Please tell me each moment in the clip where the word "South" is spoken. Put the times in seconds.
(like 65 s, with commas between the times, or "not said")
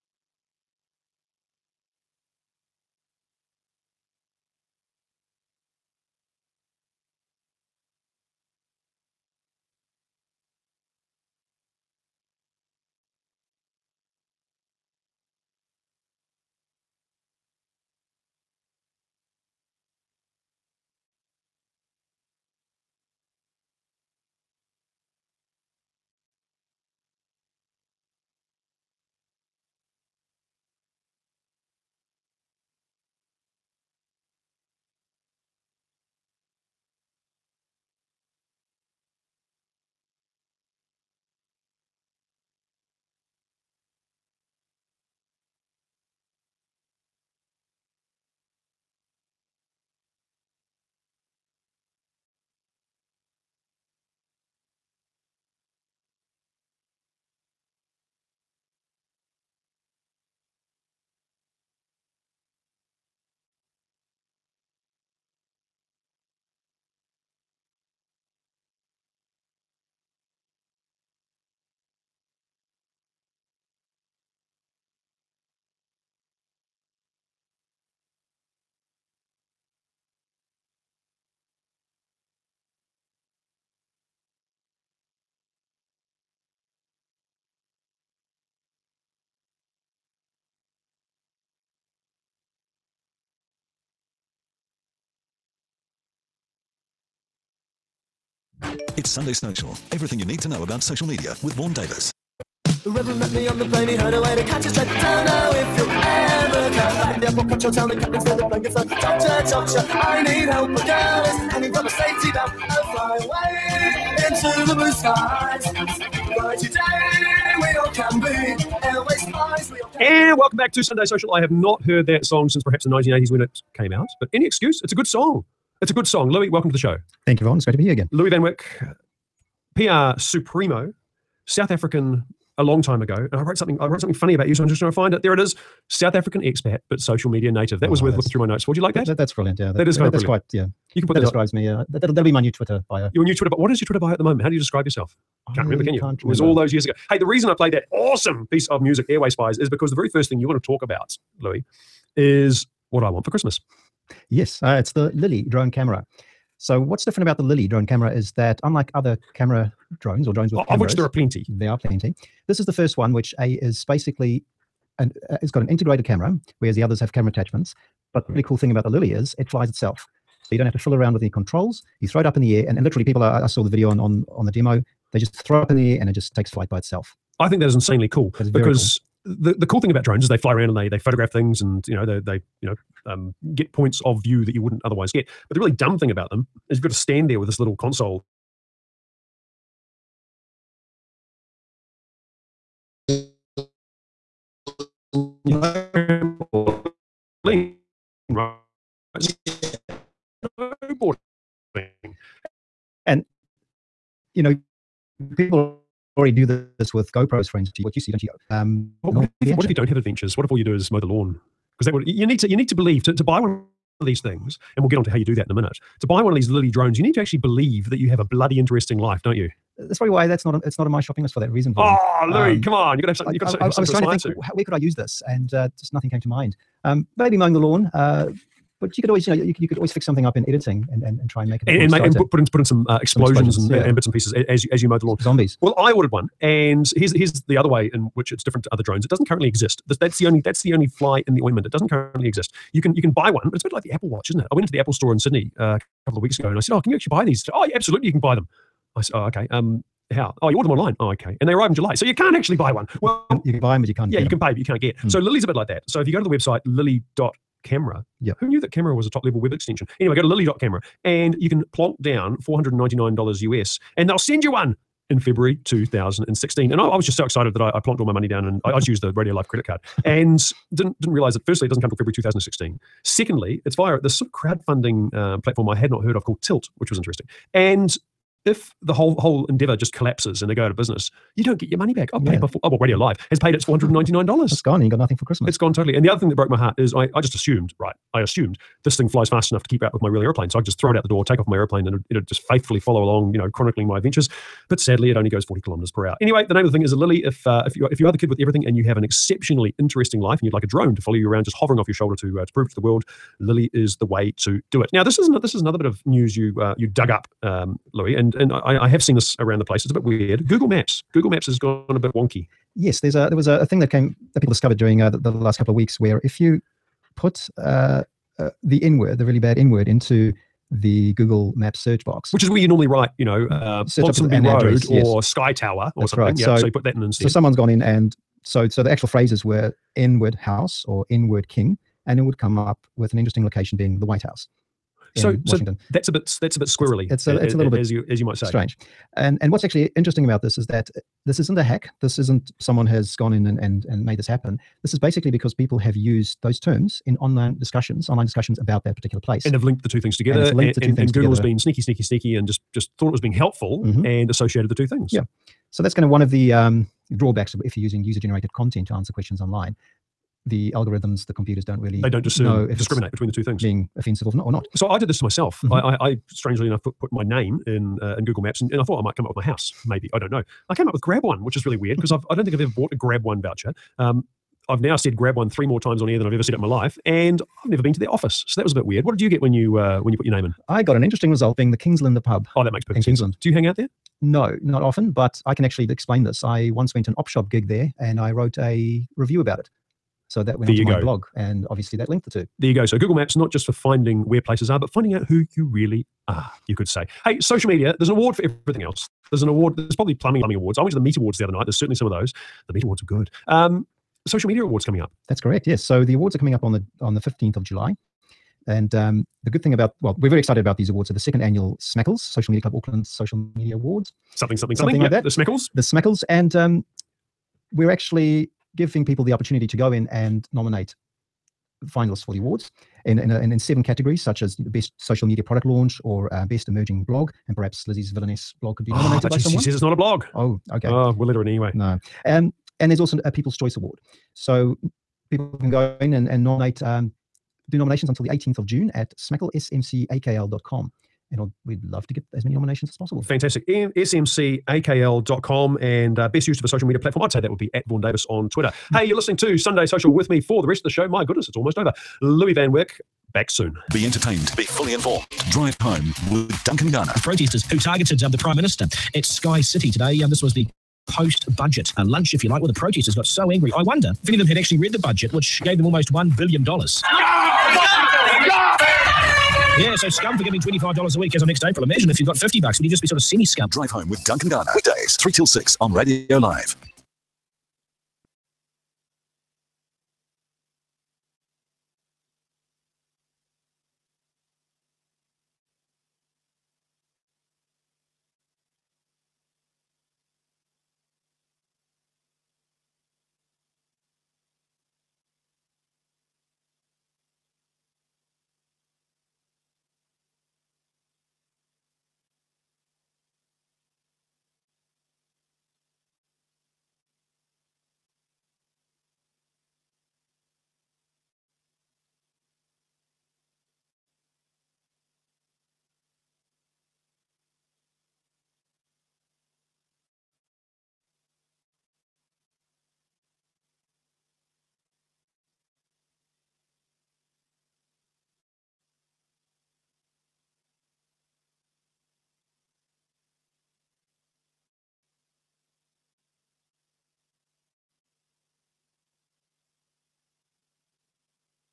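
131 s, 135 s.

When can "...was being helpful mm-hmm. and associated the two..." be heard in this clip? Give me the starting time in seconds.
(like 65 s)
353 s.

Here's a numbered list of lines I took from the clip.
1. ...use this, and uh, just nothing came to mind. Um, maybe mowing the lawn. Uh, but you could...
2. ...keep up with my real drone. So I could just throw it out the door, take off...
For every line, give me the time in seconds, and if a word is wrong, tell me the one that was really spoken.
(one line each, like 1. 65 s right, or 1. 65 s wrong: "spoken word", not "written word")
1. 224 s right
2. 289 s wrong: "airplane", not "drone".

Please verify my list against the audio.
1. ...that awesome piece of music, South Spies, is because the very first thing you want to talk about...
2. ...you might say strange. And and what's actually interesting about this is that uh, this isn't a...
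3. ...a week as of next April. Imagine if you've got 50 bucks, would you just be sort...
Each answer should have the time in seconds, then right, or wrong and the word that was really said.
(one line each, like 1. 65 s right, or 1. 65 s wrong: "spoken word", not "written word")
1. 147 s wrong: "Airway", not "South"
2. 338 s right
3. 471 s right.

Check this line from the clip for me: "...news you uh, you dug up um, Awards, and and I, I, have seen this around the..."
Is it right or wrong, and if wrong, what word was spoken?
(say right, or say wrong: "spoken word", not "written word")
wrong: "Louis", not "Awards".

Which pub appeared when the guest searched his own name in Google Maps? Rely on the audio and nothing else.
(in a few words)
Kingslander.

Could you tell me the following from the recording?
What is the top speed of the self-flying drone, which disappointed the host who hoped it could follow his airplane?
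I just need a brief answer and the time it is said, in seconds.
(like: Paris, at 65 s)
40 km/h, at 295 s.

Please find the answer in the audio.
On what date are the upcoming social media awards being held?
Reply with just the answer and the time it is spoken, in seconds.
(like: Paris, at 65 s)
15 July, at 407 s.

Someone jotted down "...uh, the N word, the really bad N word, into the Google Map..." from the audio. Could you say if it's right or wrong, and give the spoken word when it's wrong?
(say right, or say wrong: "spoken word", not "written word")
right.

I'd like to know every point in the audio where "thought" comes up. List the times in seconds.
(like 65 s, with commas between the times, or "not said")
352 s, 368 s.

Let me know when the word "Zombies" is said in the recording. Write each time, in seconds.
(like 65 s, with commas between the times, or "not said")
235 s.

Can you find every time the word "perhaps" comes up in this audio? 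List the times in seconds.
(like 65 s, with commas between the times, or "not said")
122 s, 427 s.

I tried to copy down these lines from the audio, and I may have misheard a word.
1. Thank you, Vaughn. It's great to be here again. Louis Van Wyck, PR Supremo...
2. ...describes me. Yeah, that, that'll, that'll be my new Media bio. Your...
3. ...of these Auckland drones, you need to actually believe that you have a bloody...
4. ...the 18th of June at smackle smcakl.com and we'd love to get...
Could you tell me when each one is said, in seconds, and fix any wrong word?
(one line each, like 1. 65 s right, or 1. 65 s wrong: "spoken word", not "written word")
1. 127 s right
2. 141 s wrong: "Twitter", not "Media"
3. 216 s wrong: "Lily", not "Auckland"
4. 438 s right.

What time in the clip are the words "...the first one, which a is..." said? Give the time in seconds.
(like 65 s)
162 s.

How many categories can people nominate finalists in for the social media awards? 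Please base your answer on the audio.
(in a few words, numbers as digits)
Seven.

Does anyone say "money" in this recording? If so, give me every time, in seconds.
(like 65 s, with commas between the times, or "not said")
268 s, 281 s.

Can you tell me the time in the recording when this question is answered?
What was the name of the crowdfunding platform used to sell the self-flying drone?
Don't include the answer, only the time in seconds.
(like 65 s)
276 s.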